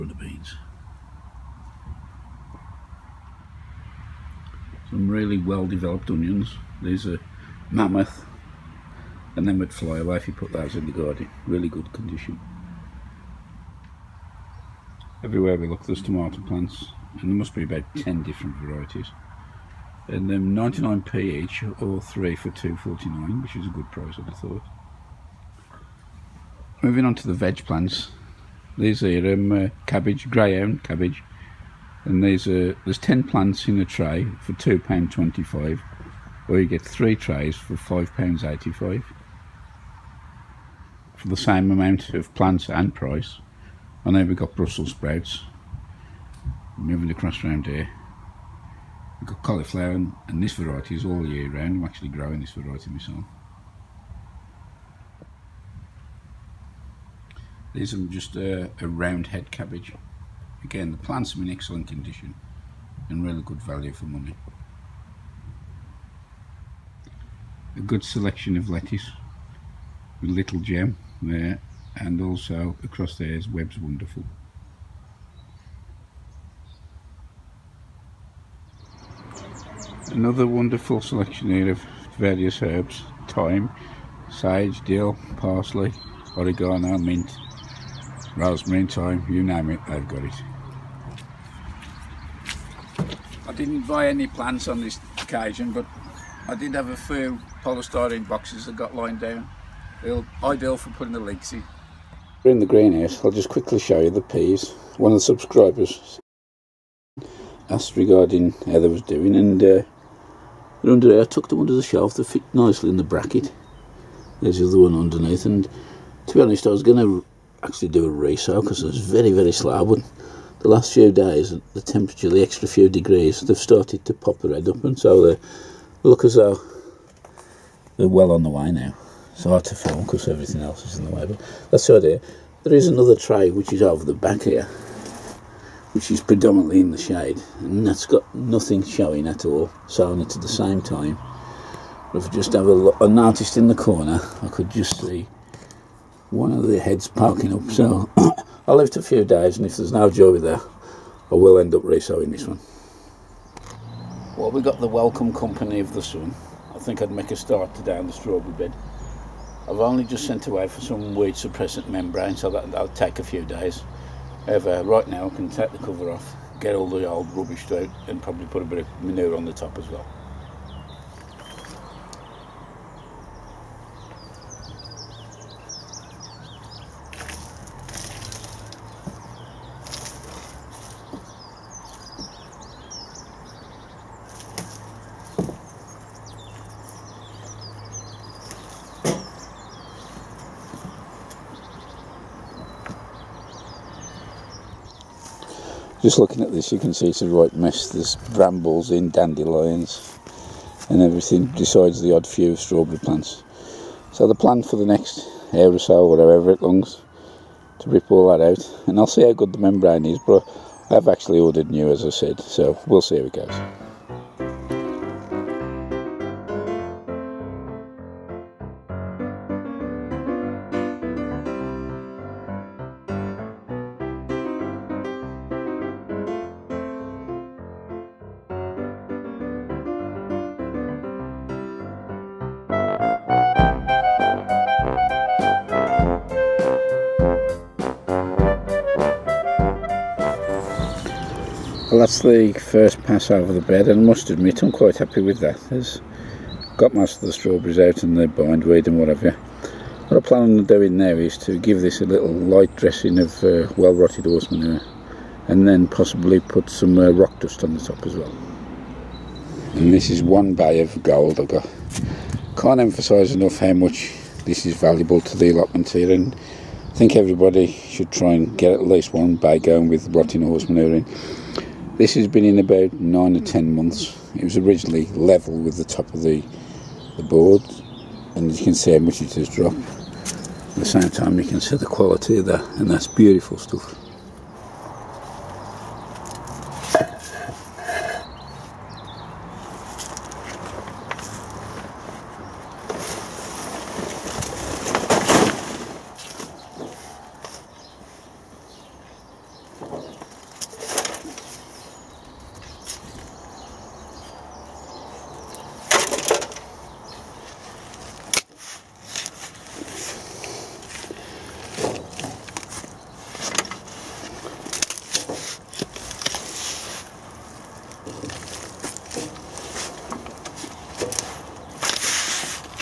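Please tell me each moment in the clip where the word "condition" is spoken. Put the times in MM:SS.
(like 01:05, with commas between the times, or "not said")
00:11, 01:01.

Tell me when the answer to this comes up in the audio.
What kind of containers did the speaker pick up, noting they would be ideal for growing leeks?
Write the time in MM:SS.
01:37.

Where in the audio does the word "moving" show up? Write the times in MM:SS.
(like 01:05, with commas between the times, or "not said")
00:26, 00:46.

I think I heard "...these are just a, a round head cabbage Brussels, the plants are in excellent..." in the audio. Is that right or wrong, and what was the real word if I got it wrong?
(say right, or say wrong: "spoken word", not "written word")
wrong: "Again", not "Brussels".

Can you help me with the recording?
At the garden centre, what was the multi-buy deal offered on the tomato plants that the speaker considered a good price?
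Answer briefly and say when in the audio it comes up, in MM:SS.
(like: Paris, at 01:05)
3 for £2.49, at 00:21.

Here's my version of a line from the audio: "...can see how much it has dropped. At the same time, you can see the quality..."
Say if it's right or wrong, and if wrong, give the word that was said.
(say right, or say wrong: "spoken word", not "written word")
right.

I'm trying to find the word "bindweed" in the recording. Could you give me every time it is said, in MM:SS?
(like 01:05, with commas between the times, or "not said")
04:08.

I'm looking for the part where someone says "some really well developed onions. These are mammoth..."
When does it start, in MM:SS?
00:04.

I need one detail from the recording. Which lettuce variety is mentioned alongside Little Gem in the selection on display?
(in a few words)
Webbs Wonderful.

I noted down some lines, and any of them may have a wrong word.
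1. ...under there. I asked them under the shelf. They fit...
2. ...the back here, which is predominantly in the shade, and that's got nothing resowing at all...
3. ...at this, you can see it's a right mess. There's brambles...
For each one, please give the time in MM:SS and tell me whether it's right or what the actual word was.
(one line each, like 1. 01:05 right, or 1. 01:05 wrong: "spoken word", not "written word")
1. 01:50 wrong: "tucked", not "asked"
2. 02:14 wrong: "showing", not "resowing"
3. 03:16 right.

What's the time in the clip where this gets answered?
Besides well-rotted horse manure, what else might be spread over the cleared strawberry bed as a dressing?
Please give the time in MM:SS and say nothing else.
04:17.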